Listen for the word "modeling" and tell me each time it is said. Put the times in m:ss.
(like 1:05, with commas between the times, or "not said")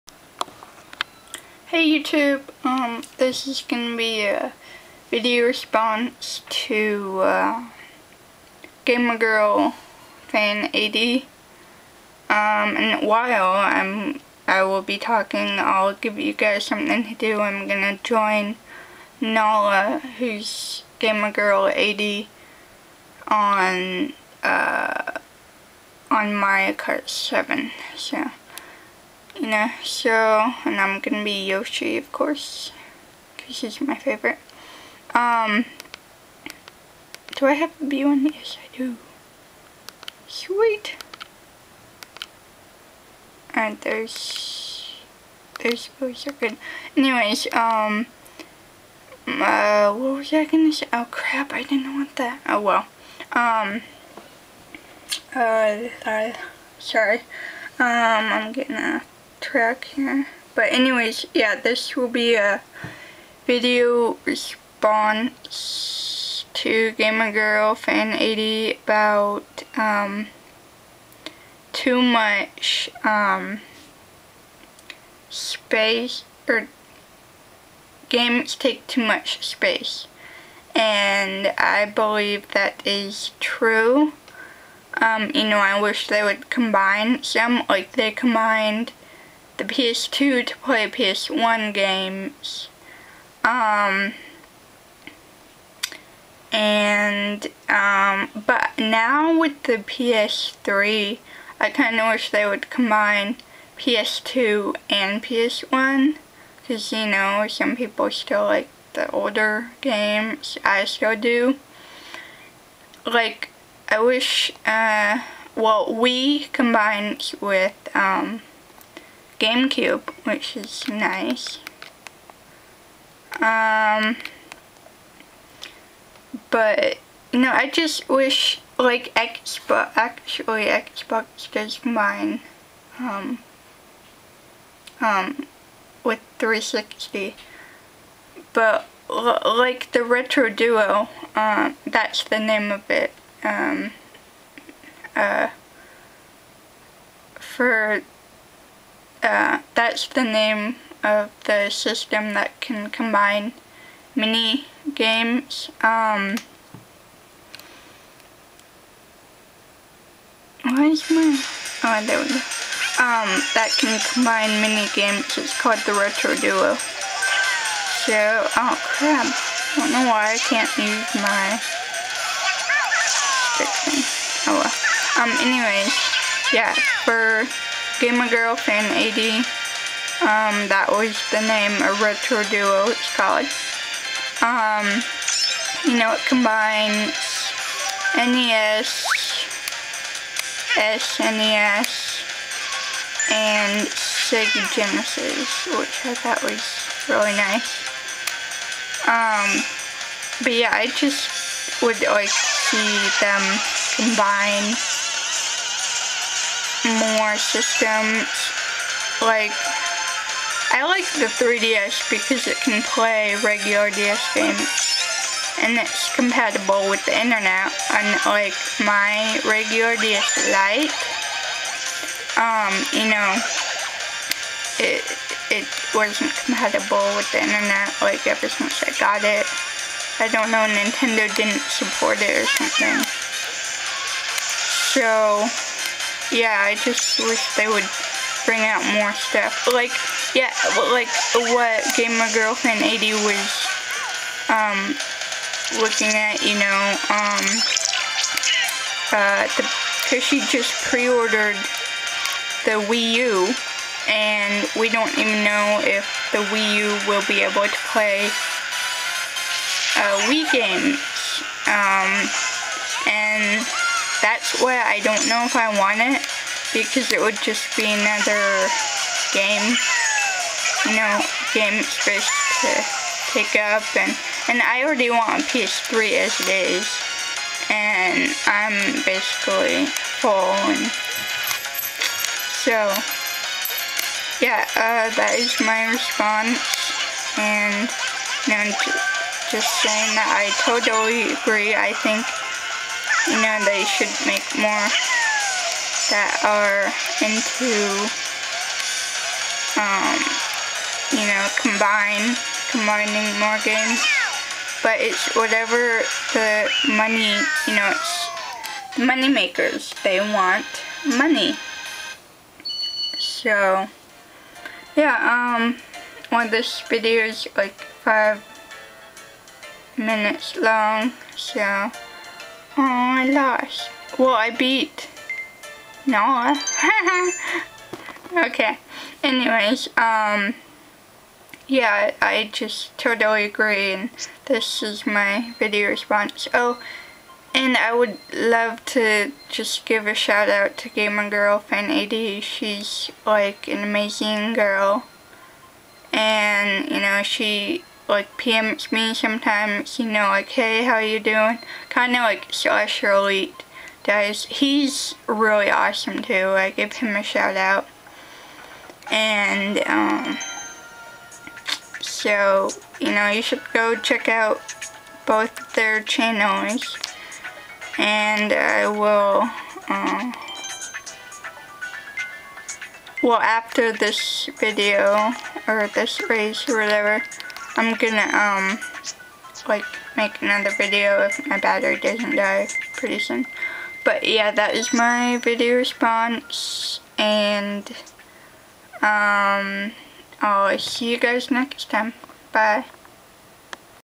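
not said.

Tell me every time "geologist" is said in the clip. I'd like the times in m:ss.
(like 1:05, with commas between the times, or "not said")
not said.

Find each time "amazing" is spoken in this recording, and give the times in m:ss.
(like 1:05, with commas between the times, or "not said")
5:43.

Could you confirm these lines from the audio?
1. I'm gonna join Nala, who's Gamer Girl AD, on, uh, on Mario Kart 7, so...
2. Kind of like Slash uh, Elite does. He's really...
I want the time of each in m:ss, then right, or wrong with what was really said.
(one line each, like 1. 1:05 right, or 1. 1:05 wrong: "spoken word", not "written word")
1. 0:17 right
2. 5:51 right.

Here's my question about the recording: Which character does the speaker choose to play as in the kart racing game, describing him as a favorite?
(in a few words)
Yoshi.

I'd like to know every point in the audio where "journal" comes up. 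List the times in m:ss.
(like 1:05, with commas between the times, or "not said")
not said.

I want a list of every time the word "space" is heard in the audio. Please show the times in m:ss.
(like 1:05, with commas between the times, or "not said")
1:15, 1:19, 4:31.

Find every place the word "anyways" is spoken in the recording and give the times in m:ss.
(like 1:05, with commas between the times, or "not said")
0:46, 1:00, 2:55, 5:29.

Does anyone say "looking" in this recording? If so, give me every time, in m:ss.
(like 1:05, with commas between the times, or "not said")
4:05.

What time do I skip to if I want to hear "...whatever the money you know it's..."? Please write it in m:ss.
5:05.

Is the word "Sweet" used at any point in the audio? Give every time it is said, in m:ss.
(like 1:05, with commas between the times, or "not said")
0:40.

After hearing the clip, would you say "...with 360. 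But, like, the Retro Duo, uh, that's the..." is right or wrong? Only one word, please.
right.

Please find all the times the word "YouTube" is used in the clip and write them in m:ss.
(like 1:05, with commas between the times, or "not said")
0:01.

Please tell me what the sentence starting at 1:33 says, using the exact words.
Um, and, um, but now with the PS3, I kind of wish they would combine PS2 and PS1.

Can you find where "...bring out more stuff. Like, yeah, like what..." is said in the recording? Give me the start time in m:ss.
3:58.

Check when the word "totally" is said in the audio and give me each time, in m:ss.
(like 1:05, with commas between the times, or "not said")
4:50, 5:32.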